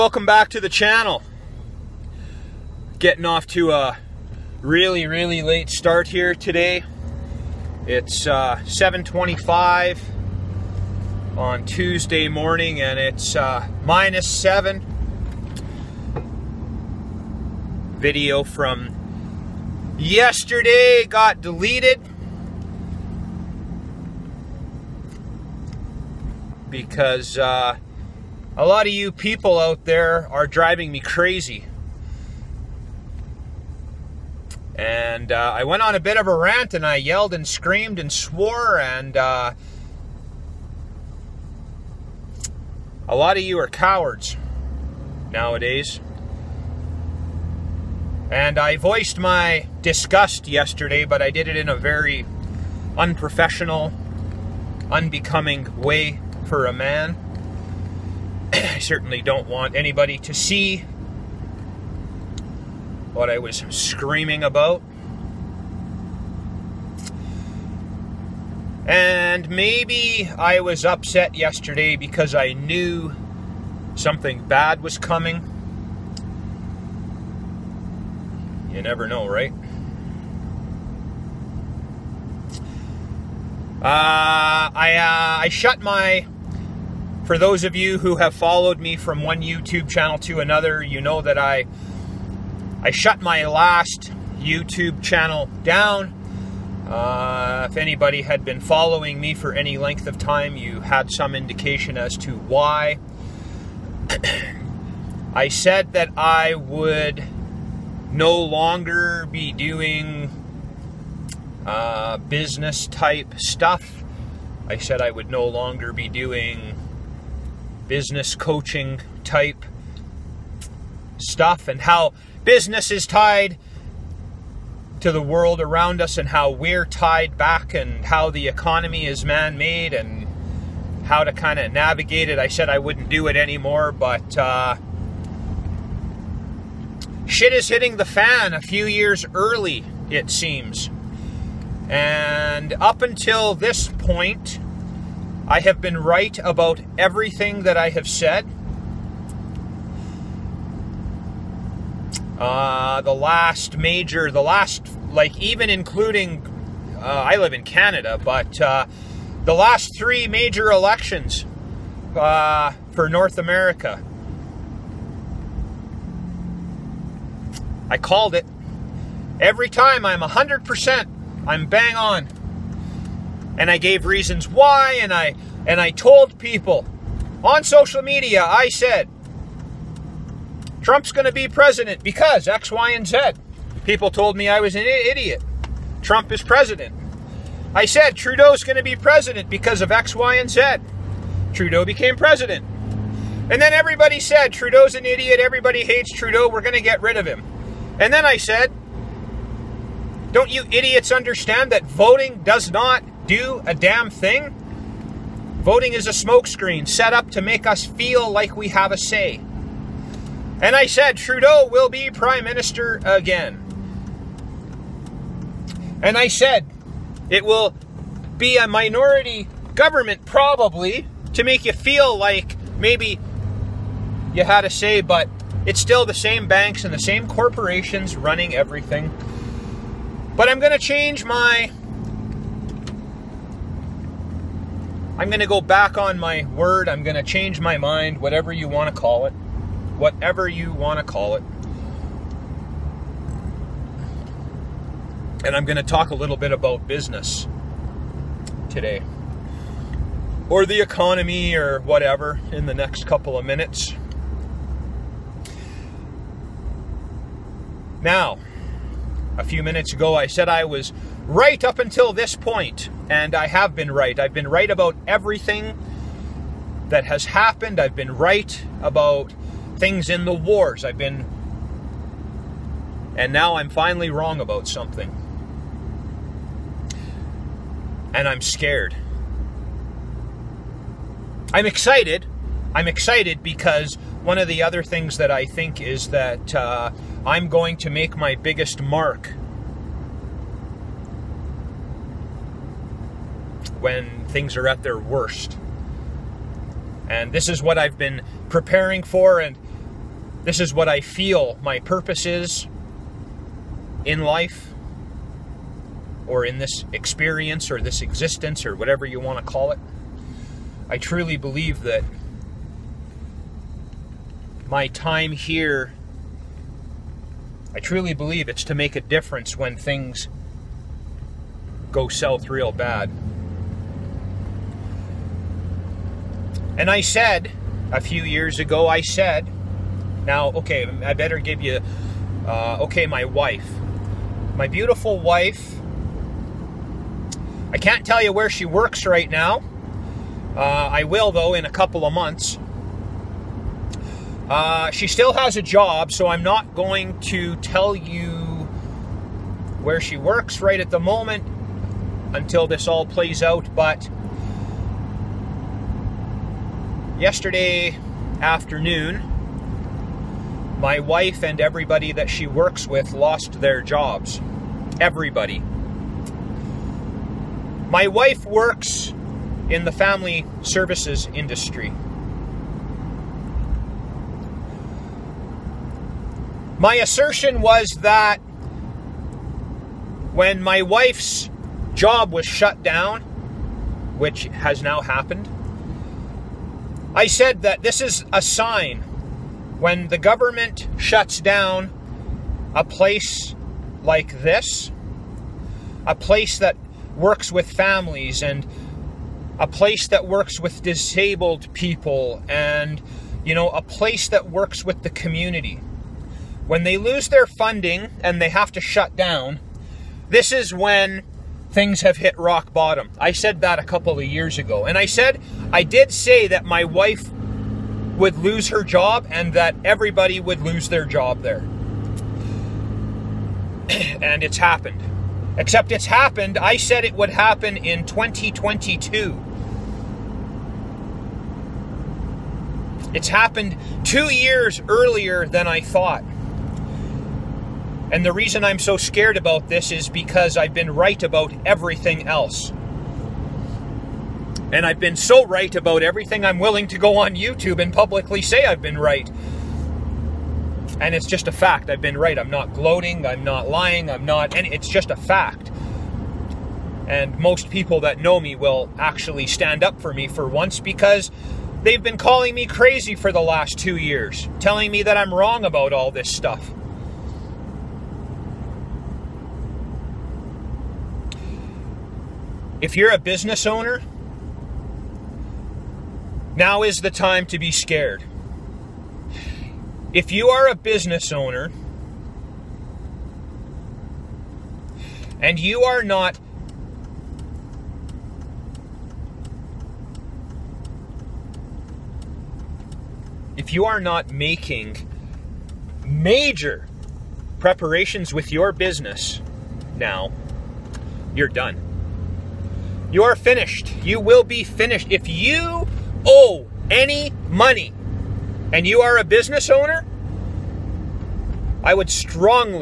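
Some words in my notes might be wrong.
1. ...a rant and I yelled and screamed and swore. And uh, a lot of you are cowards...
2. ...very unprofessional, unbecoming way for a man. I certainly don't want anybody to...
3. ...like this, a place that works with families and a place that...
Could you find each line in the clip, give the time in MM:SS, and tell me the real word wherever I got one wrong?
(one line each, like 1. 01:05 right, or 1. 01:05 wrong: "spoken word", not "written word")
1. 00:36 right
2. 00:51 right
3. 06:34 right.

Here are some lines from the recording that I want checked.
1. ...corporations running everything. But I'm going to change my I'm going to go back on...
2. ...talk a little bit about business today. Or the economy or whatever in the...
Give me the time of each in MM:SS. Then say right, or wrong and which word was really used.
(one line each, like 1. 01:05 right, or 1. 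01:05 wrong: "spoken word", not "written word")
1. 03:47 right
2. 04:05 right.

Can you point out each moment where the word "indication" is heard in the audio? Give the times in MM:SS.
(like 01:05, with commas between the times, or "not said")
01:41.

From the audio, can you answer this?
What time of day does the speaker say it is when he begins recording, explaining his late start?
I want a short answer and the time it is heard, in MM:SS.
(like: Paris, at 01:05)
7:25, at 00:08.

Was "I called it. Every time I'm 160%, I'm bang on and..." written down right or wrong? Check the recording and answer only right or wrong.
wrong.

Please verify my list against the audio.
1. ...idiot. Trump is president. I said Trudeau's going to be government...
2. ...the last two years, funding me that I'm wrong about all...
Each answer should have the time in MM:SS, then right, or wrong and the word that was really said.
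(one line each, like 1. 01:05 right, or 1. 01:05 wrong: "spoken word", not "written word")
1. 03:04 wrong: "president", not "government"
2. 07:43 wrong: "telling", not "funding".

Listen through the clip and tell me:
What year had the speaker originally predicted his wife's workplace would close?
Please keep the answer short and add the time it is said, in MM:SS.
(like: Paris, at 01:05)
2022, at 07:08.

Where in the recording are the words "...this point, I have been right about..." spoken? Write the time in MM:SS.
02:23.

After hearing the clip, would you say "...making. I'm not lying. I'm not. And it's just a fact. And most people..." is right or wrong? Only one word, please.
wrong.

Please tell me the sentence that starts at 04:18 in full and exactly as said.
Now, a few minutes ago, I said I was right up until this point, and I have been right.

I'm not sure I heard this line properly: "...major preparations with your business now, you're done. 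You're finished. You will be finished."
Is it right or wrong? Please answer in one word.
right.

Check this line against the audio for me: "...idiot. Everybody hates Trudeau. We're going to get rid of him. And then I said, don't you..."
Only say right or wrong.
right.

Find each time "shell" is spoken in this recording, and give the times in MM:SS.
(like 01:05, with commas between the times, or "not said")
not said.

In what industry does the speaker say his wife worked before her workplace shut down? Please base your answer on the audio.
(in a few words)
Family services.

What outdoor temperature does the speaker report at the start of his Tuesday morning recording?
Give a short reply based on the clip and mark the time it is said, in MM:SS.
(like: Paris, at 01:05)
-7, at 00:13.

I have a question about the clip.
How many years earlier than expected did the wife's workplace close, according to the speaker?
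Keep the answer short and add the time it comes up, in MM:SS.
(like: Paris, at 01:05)
2, at 07:14.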